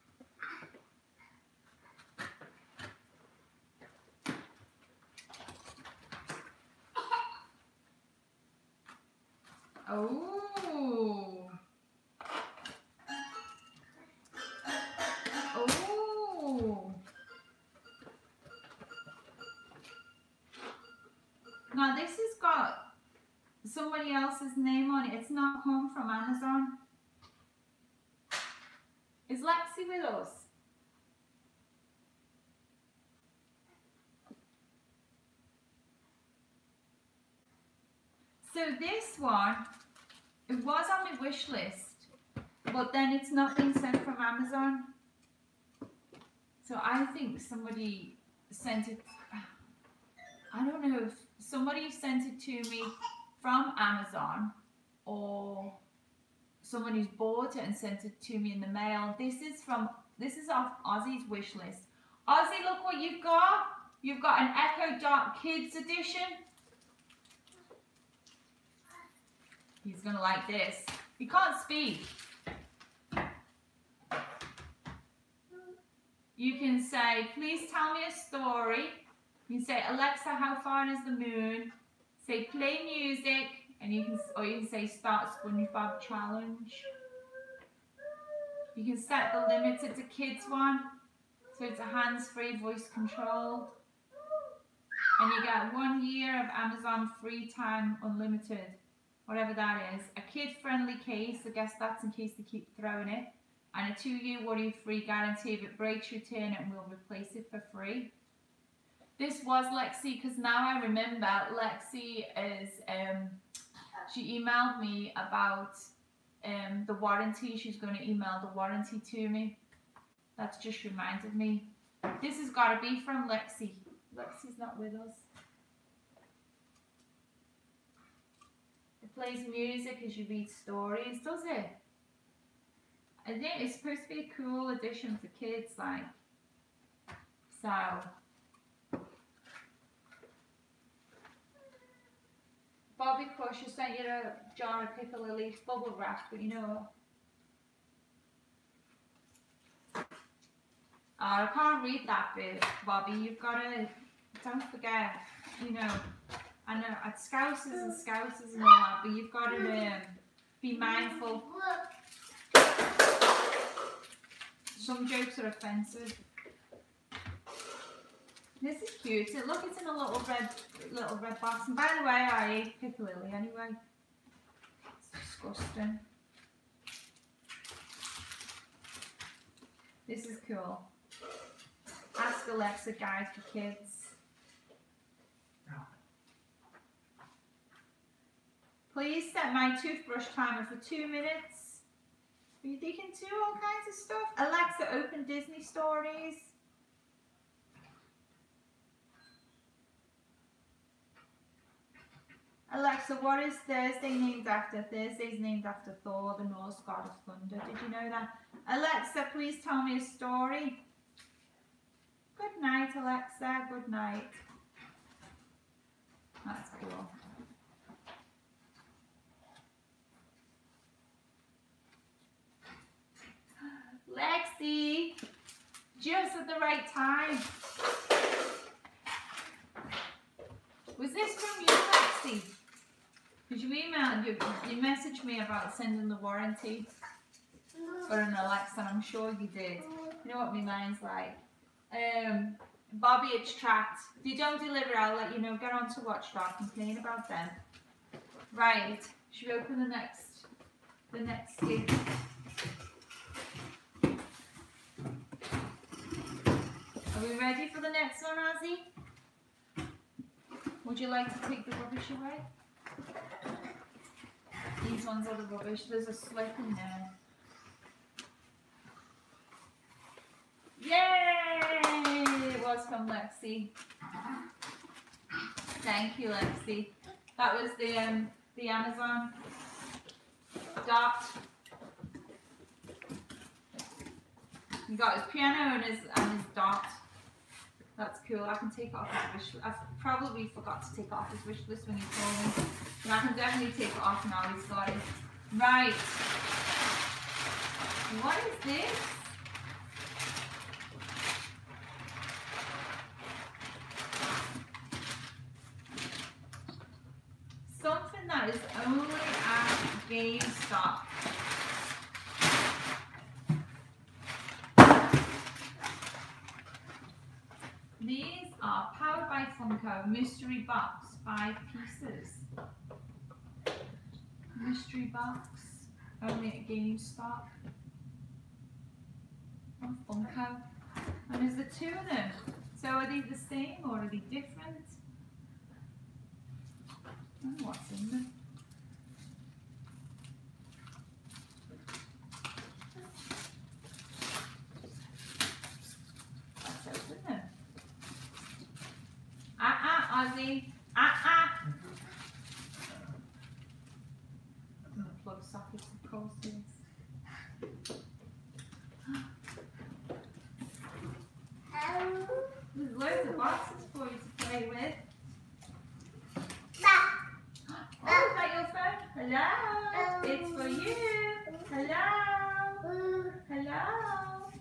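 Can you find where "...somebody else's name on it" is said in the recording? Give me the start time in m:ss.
0:23.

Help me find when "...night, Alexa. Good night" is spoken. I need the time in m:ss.
3:32.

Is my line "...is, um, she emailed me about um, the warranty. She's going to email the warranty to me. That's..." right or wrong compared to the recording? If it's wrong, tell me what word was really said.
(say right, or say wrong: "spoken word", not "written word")
right.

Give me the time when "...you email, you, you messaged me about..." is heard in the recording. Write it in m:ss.
3:53.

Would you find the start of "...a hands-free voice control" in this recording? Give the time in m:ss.
1:31.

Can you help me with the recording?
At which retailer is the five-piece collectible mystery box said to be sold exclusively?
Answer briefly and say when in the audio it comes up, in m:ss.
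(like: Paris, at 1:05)
GameStop, at 5:26.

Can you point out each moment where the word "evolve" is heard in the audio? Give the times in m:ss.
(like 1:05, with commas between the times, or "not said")
not said.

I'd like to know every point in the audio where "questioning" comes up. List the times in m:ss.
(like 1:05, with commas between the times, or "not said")
not said.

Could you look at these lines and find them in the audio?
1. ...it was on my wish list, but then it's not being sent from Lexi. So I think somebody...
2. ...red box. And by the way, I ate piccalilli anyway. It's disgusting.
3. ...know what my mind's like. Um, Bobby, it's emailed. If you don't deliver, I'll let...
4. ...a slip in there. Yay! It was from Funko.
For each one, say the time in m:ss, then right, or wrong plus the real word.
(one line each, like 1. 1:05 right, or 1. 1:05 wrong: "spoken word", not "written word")
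1. 0:40 wrong: "Amazon", not "Lexi"
2. 2:51 right
3. 4:00 wrong: "tracked", not "emailed"
4. 4:26 wrong: "Lexi", not "Funko".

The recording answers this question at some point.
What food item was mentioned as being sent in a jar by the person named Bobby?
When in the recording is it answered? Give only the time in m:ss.
2:24.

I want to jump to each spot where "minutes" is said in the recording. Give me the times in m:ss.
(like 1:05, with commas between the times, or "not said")
3:11.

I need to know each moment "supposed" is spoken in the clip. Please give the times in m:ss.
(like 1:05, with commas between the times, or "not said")
2:13.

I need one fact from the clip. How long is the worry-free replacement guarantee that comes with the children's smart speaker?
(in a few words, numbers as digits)
two-year.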